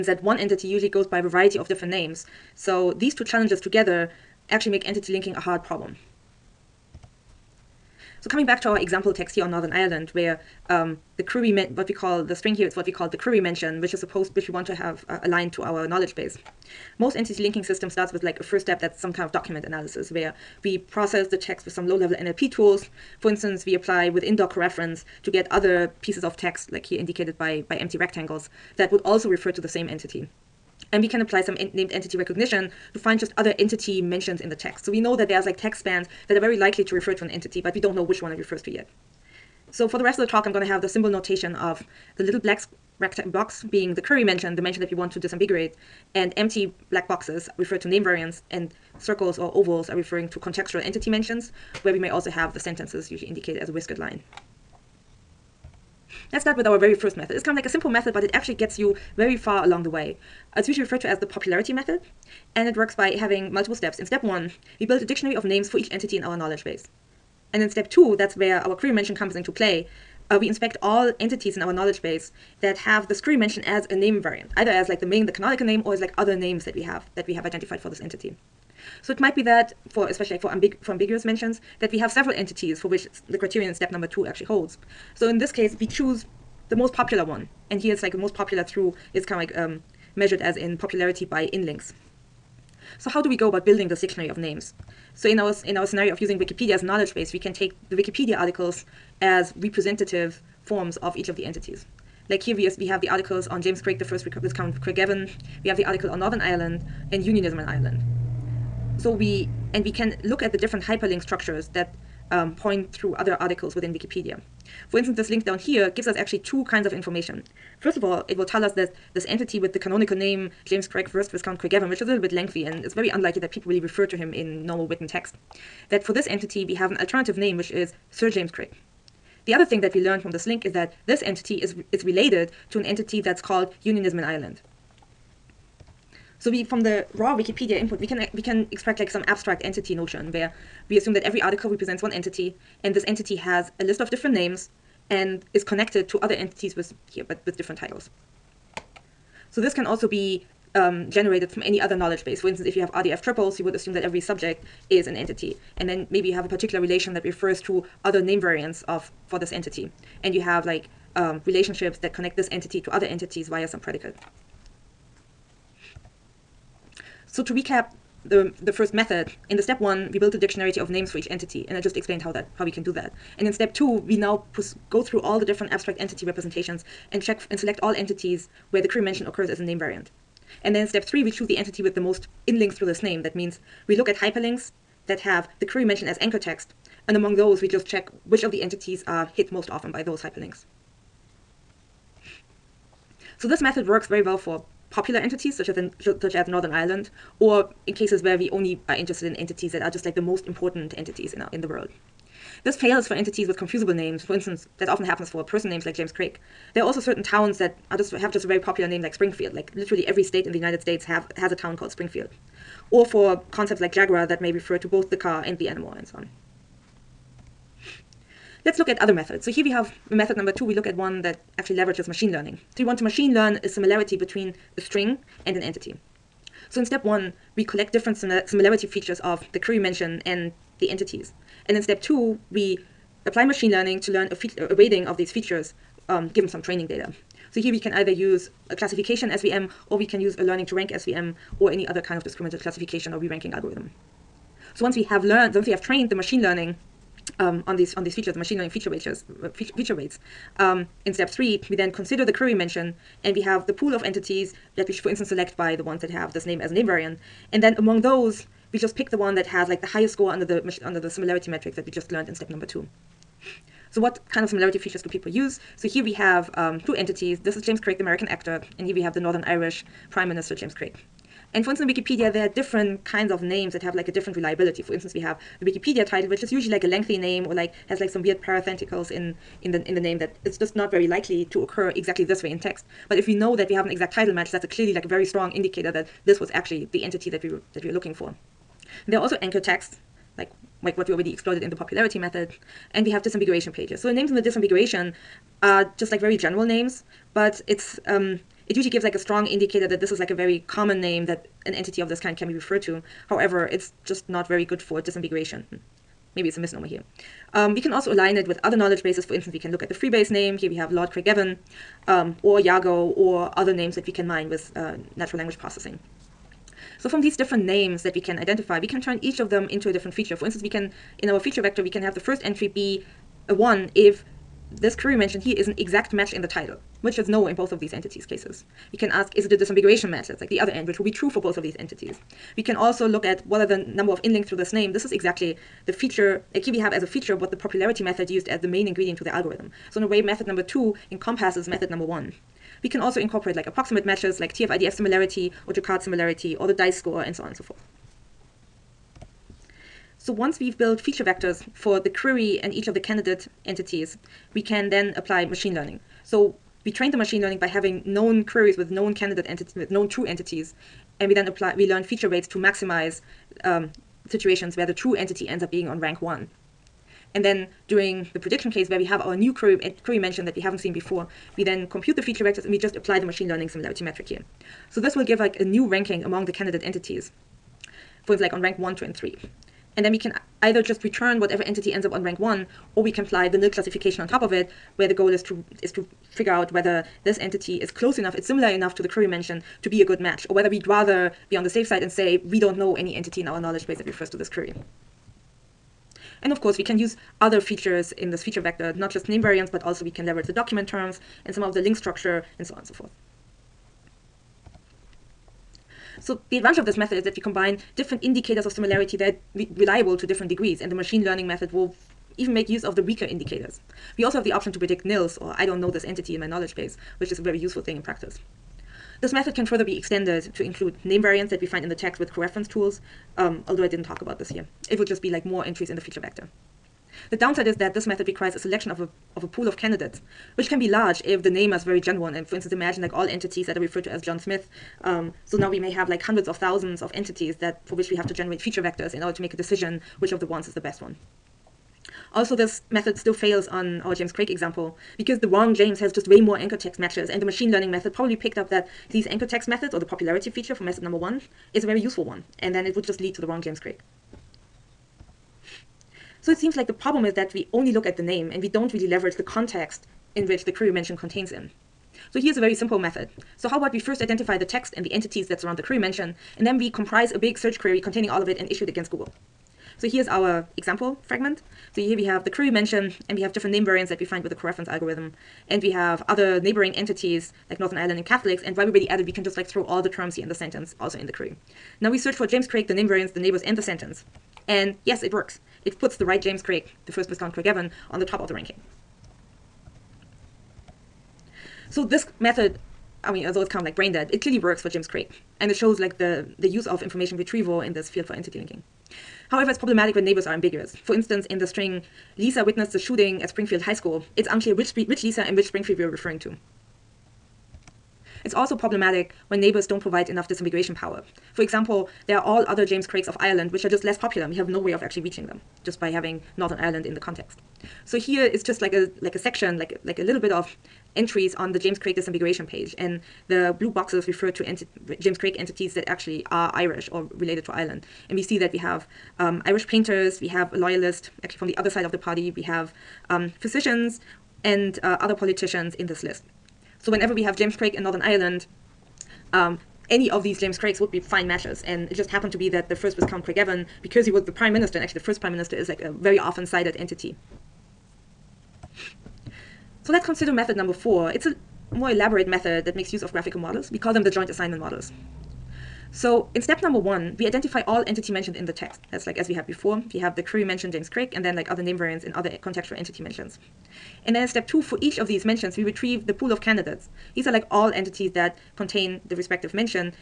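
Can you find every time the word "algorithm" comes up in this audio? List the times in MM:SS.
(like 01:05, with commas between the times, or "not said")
04:03, 05:39, 07:54.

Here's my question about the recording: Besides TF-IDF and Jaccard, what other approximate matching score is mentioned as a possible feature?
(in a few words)
Dice score.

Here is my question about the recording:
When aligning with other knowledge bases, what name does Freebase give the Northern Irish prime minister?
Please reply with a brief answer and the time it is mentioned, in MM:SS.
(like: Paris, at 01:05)
Lord Craigavon, at 05:10.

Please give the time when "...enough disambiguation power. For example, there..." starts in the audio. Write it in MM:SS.
08:30.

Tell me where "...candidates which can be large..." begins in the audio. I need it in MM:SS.
07:09.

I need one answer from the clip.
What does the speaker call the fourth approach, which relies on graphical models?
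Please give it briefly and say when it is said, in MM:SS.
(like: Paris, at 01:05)
Joint assignment models, at 09:14.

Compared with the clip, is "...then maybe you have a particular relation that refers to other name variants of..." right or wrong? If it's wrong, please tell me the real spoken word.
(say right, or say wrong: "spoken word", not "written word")
right.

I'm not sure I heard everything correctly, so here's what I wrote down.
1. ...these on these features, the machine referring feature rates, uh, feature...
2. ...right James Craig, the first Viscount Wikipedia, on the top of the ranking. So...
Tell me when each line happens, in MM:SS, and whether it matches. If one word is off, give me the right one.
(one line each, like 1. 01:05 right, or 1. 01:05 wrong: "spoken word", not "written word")
1. 04:07 wrong: "learning", not "referring"
2. 08:06 wrong: "Craigavon", not "Wikipedia".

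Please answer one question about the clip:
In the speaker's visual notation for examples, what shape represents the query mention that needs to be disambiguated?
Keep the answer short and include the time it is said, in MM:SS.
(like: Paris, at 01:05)
Little black rectangular box, at 00:42.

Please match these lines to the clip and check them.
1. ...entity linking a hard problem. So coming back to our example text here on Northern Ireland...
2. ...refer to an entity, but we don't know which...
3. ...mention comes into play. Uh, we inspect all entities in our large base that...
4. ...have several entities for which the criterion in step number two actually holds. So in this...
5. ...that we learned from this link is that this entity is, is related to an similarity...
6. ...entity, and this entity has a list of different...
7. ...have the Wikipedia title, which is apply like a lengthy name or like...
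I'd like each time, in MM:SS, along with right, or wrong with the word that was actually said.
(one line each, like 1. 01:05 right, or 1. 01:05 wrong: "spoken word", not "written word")
1. 00:04 right
2. 00:36 right
3. 01:08 wrong: "knowledge", not "large"
4. 01:21 right
5. 02:09 wrong: "entity", not "similarity"
6. 02:22 right
7. 04:35 wrong: "usually", not "apply".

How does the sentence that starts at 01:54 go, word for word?
For instance, this link down here gives us actually two kinds of information.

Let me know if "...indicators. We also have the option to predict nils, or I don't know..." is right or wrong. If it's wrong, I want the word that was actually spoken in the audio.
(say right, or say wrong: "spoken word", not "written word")
right.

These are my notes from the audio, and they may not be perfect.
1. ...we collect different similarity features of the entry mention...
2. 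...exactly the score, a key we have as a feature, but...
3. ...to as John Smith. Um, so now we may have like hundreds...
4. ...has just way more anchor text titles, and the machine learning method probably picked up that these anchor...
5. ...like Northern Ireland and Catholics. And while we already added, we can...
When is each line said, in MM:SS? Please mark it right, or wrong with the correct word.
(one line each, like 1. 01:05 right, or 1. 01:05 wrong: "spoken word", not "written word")
1. 03:47 wrong: "query", not "entry"
2. 05:35 wrong: "feature", not "score"
3. 07:14 right
4. 07:25 wrong: "matches", not "titles"
5. 07:57 right.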